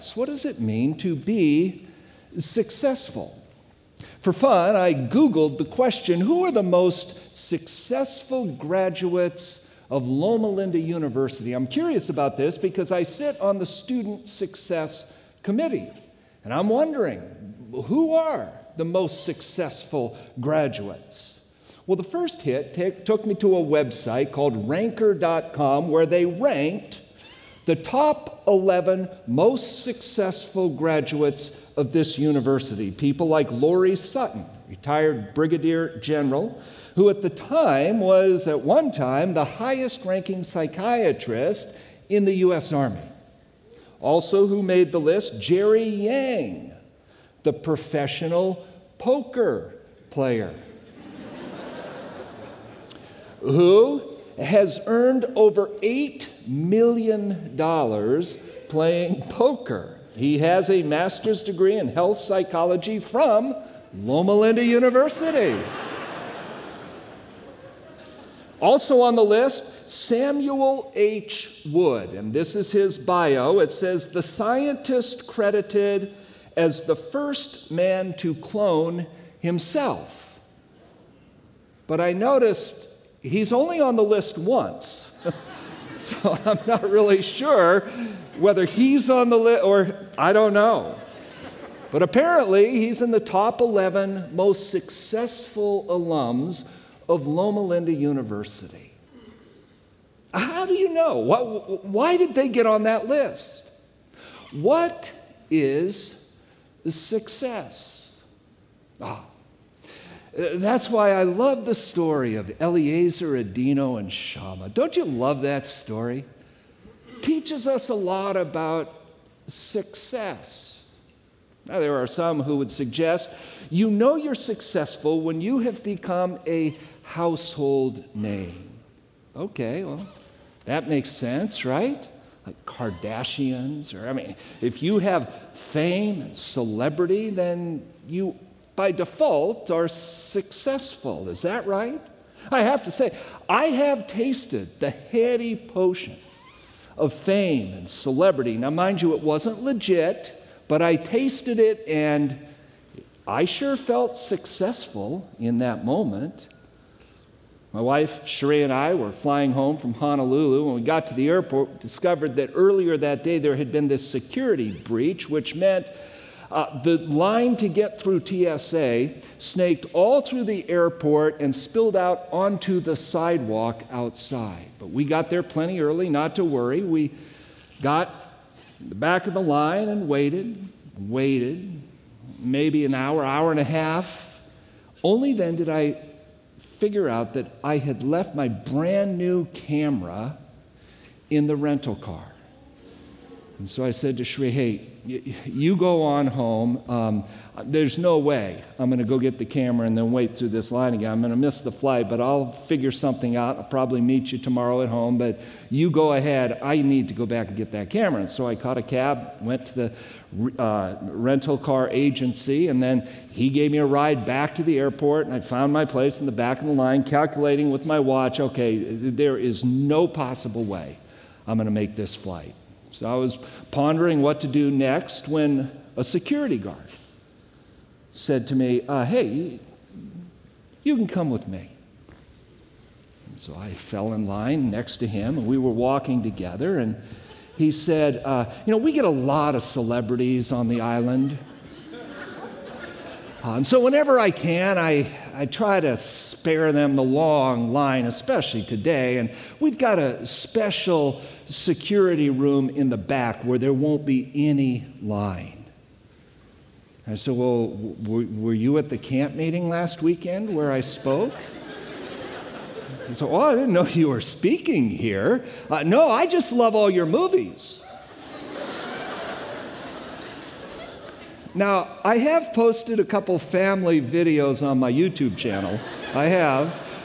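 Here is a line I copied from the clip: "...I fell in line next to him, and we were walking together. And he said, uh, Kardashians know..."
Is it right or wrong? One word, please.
wrong.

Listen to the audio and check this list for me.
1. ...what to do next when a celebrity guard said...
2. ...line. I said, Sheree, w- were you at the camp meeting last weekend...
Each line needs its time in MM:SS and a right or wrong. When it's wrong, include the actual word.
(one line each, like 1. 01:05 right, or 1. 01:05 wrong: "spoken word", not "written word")
1. 03:44 wrong: "security", not "celebrity"
2. 04:15 wrong: "Well", not "Sheree".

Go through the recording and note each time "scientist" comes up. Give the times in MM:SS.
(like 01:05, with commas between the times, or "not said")
01:14.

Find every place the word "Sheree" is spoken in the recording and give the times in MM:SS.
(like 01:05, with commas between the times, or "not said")
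02:38, 03:14.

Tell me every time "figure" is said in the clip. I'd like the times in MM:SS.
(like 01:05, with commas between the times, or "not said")
03:06, 03:22.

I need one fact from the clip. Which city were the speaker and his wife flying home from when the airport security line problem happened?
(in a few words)
Honolulu.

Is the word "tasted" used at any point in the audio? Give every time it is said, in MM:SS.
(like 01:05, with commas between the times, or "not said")
02:24, 02:30.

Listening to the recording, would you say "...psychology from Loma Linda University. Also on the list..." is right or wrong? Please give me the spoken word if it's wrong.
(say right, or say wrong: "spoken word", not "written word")
right.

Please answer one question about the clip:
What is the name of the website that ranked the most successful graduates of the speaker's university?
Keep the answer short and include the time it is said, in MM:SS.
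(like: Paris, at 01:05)
ranker.com, at 00:24.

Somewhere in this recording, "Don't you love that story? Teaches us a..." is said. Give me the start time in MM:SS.
01:54.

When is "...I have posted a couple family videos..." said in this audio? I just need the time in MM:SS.
04:32.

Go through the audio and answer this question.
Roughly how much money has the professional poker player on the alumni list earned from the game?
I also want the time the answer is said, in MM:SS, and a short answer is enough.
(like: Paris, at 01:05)
$8 million, at 00:55.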